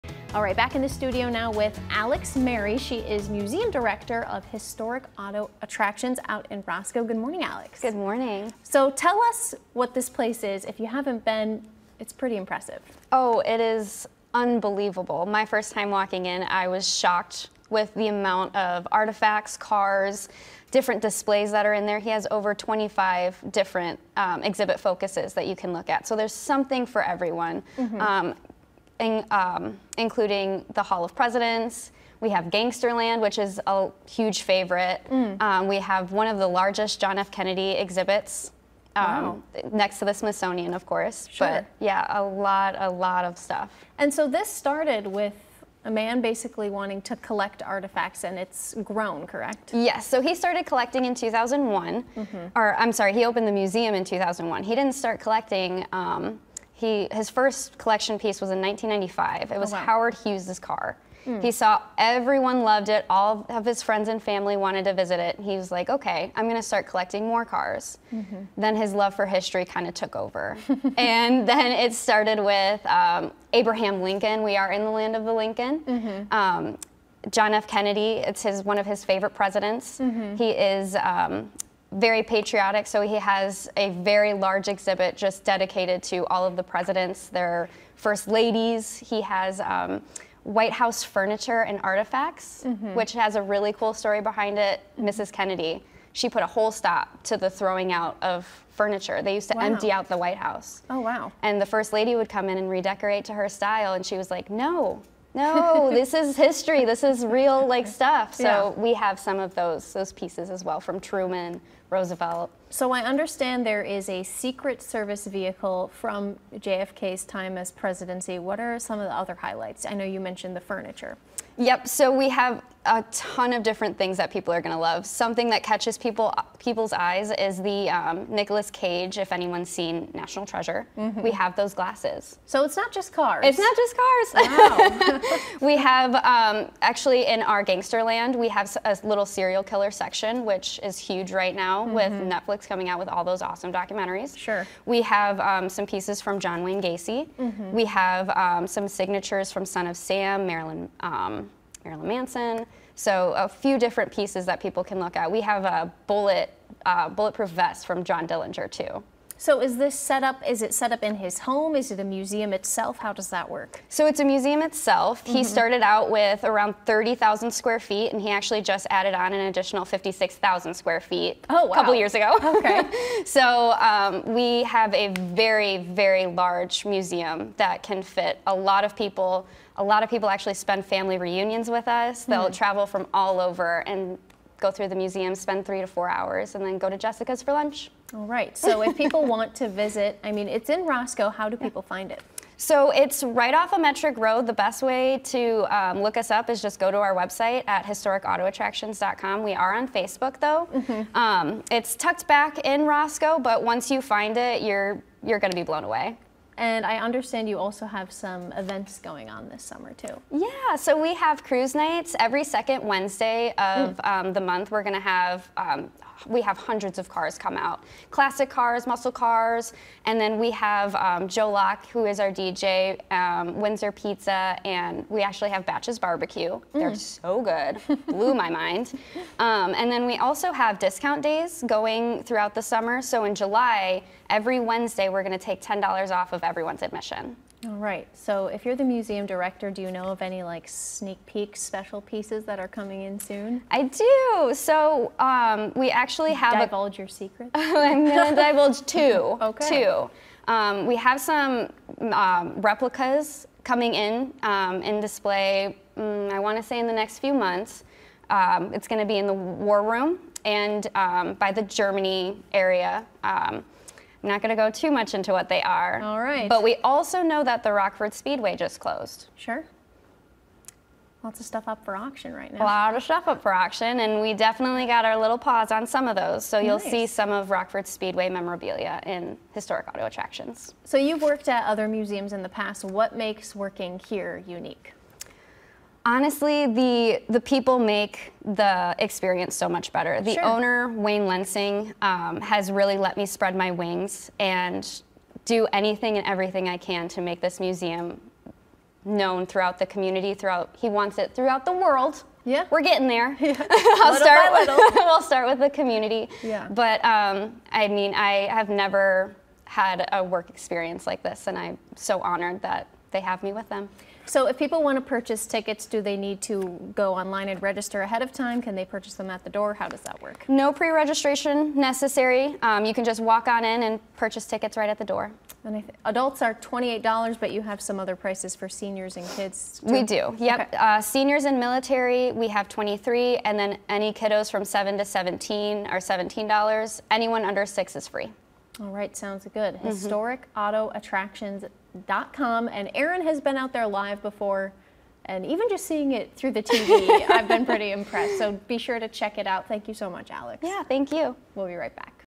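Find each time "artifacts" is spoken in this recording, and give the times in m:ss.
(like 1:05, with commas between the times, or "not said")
0:18, 0:47, 1:31.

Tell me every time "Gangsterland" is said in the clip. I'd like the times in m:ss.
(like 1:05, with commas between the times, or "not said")
0:32, 2:17.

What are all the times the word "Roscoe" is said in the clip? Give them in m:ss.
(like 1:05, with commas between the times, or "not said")
0:06, 3:10, 3:22.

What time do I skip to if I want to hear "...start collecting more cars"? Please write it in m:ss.
1:06.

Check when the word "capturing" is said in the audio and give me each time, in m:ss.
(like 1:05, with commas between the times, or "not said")
not said.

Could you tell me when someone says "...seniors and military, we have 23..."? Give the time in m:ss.
5:31.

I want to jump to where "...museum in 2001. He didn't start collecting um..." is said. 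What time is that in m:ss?
0:53.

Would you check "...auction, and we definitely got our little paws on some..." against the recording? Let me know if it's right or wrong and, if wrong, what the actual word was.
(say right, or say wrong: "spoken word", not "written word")
right.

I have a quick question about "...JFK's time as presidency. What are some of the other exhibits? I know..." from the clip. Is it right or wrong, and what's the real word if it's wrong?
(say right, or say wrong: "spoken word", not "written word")
wrong: "highlights", not "exhibits".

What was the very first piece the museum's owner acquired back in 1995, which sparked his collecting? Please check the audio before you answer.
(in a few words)
Howard Hughes' car.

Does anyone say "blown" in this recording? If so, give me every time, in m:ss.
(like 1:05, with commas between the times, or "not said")
3:25.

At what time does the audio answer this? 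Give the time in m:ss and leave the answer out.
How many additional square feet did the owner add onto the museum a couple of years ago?
2:49.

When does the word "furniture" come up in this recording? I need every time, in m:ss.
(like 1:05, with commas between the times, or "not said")
1:31, 1:38, 2:00.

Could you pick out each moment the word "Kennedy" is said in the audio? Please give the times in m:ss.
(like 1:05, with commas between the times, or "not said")
0:37, 1:17, 1:35.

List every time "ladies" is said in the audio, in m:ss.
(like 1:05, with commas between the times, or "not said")
1:28.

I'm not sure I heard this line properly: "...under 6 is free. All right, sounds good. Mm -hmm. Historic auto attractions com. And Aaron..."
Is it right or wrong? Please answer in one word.
right.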